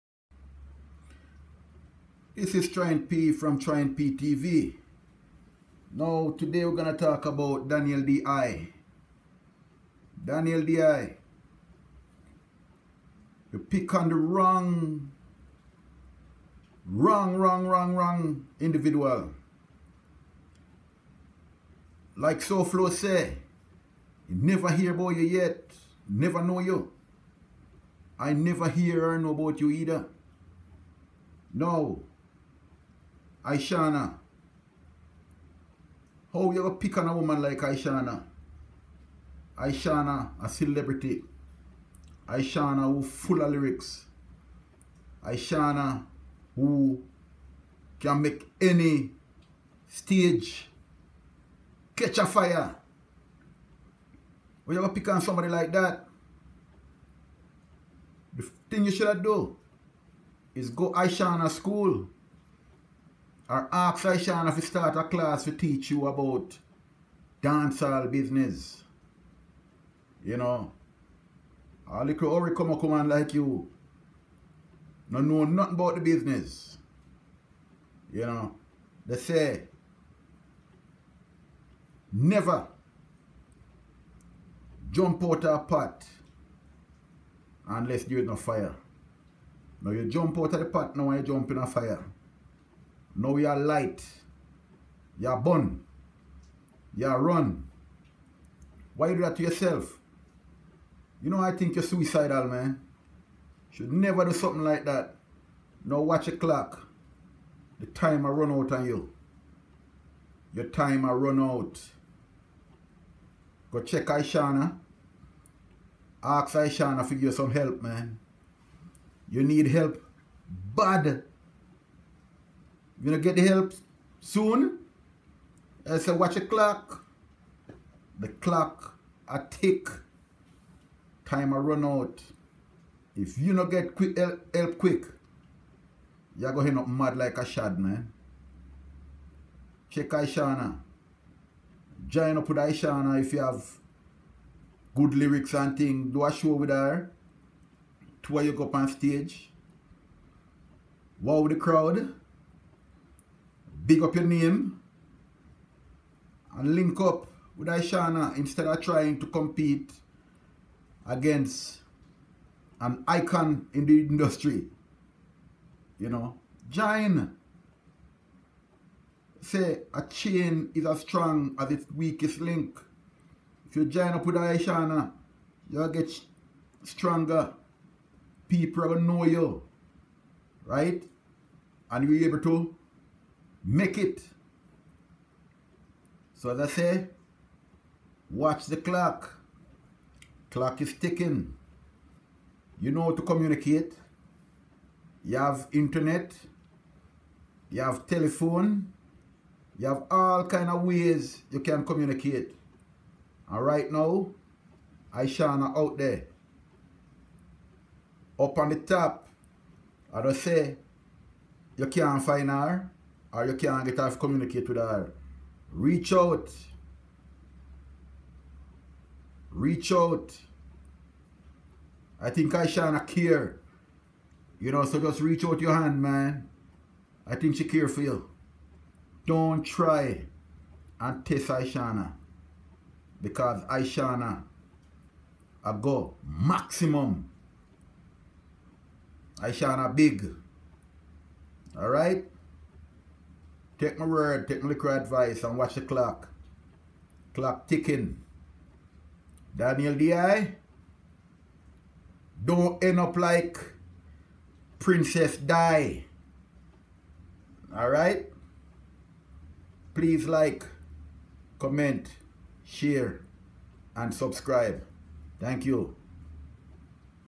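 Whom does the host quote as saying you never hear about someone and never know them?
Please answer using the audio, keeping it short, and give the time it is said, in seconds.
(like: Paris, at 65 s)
SoFlo, at 22 s.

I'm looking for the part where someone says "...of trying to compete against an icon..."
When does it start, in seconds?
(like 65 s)
158 s.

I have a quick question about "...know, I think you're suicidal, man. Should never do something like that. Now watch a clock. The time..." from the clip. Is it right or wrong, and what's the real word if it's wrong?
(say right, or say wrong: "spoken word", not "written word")
right.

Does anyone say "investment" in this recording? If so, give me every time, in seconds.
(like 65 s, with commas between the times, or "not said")
not said.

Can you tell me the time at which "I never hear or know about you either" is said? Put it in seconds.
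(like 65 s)
28 s.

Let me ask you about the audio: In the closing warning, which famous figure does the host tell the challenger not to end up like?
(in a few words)
Princess Di.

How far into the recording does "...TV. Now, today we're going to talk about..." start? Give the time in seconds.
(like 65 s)
4 s.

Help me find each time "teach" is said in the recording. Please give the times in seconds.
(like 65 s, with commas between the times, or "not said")
65 s.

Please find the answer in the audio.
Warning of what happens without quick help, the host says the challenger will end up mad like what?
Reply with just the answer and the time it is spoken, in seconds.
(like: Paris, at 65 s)
A shad, at 137 s.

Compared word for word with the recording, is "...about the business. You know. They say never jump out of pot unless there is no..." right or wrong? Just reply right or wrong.
right.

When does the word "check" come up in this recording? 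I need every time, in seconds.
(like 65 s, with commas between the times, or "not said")
113 s, 139 s.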